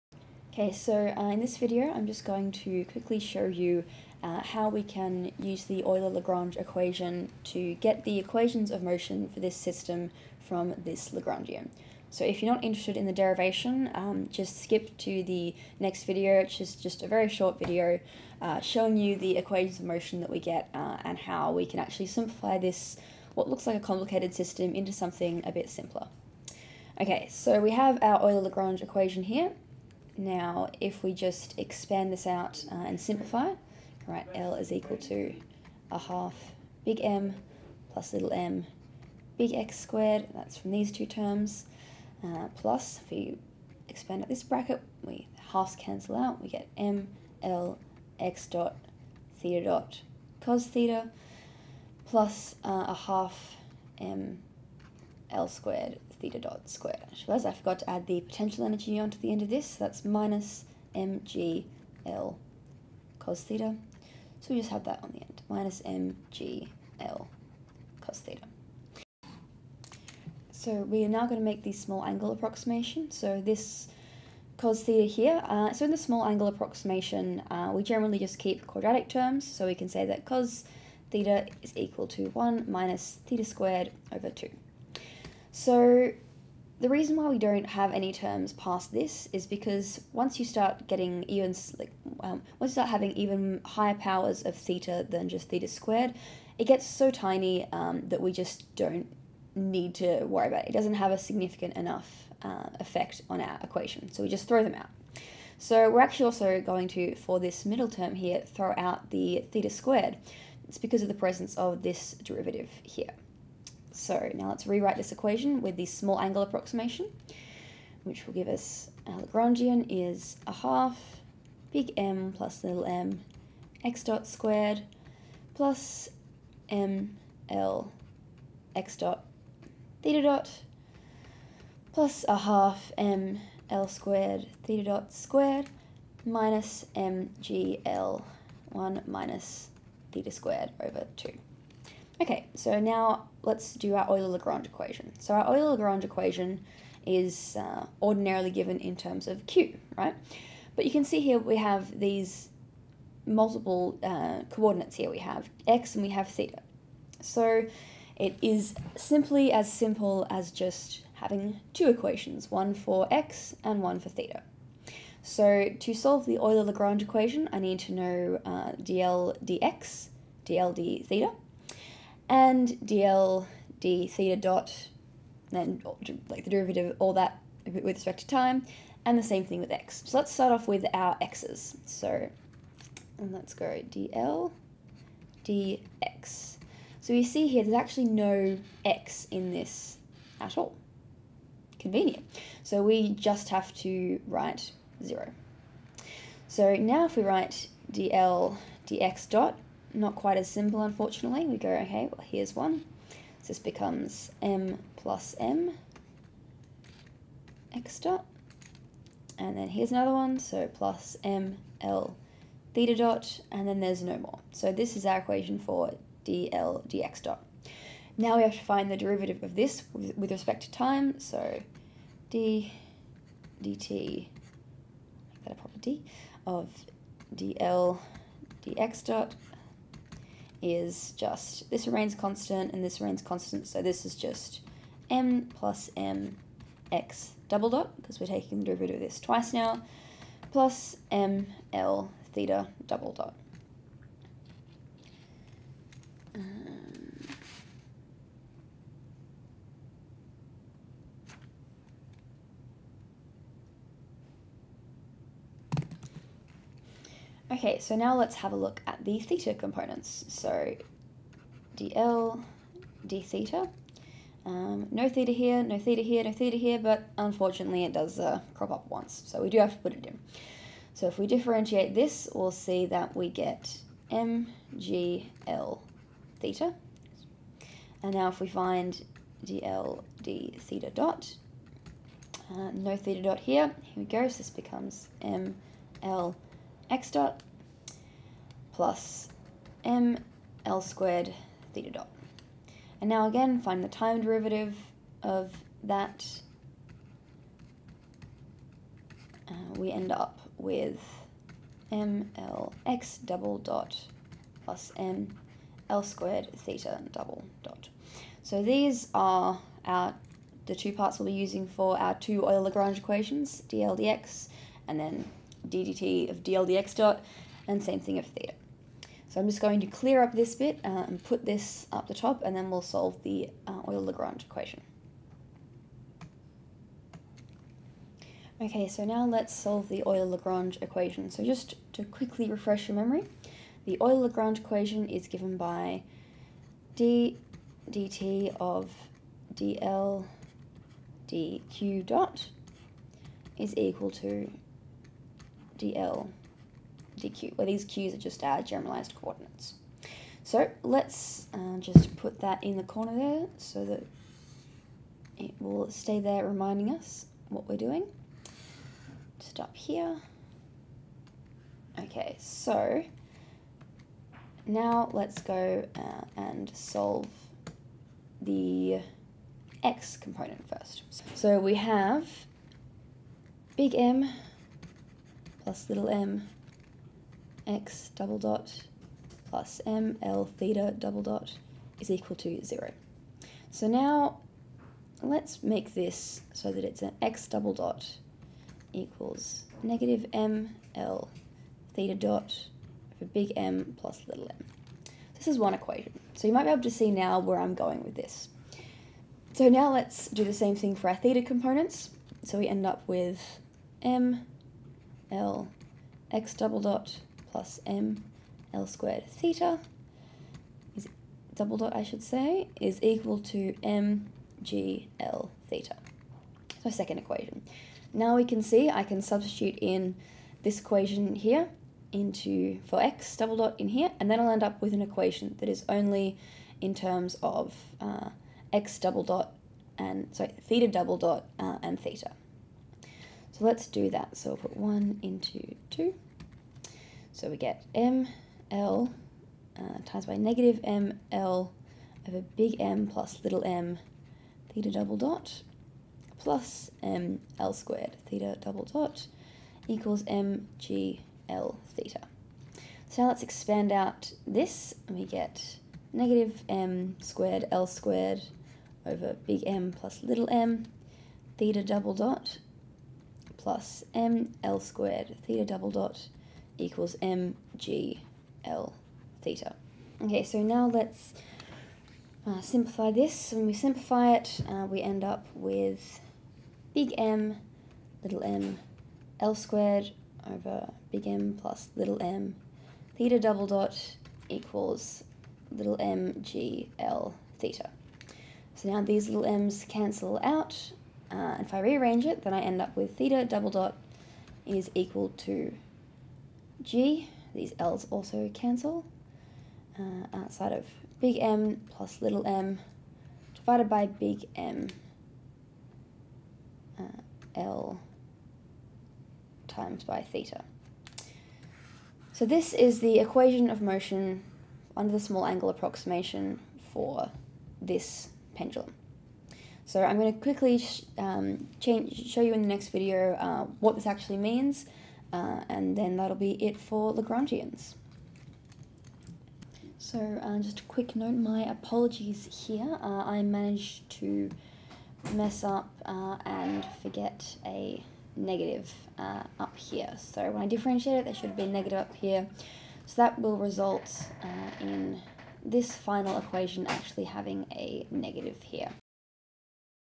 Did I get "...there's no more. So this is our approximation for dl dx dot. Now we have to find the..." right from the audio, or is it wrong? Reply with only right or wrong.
wrong.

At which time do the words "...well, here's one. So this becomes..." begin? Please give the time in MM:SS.
03:22.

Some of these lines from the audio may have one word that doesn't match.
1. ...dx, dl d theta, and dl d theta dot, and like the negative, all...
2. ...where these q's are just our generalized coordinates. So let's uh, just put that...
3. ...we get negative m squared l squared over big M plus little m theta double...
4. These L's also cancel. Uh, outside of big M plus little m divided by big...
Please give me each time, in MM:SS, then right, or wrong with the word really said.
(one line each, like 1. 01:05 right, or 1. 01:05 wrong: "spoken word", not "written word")
1. 02:49 wrong: "derivative", not "negative"
2. 05:47 right
3. 07:35 right
4. 08:17 right.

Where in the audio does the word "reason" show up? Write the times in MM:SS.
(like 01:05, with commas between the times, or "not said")
01:26.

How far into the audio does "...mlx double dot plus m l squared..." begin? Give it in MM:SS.
05:01.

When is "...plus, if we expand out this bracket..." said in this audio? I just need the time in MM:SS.
00:42.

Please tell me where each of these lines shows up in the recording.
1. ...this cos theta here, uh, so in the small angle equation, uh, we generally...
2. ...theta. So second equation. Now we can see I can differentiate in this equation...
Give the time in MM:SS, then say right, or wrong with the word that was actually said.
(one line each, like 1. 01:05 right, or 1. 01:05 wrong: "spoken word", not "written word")
1. 01:13 wrong: "approximation", not "equation"
2. 06:55 wrong: "substitute", not "differentiate".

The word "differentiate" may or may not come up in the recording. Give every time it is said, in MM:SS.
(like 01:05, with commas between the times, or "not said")
04:31, 09:00.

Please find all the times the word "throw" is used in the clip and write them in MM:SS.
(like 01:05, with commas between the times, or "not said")
01:44, 01:48.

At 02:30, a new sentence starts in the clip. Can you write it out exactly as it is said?
But you can see here we have these multiple uh, coordinates here.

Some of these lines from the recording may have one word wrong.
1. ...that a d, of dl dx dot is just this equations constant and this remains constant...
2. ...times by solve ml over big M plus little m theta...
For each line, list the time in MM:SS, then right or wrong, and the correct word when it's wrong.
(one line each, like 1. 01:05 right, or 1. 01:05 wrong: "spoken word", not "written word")
1. 03:45 wrong: "remains", not "equations"
2. 07:20 wrong: "negative", not "solve".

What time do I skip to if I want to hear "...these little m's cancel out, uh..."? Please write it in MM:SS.
08:09.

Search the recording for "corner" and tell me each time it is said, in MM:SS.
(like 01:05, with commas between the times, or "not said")
05:52.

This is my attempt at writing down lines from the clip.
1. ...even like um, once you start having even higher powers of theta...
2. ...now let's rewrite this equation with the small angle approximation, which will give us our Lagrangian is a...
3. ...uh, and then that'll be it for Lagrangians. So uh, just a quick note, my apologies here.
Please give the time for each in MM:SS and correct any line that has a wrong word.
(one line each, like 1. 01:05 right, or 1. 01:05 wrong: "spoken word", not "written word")
1. 01:31 right
2. 01:54 right
3. 08:45 right.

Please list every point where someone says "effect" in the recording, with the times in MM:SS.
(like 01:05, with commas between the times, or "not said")
01:42.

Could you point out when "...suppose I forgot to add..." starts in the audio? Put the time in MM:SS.
00:57.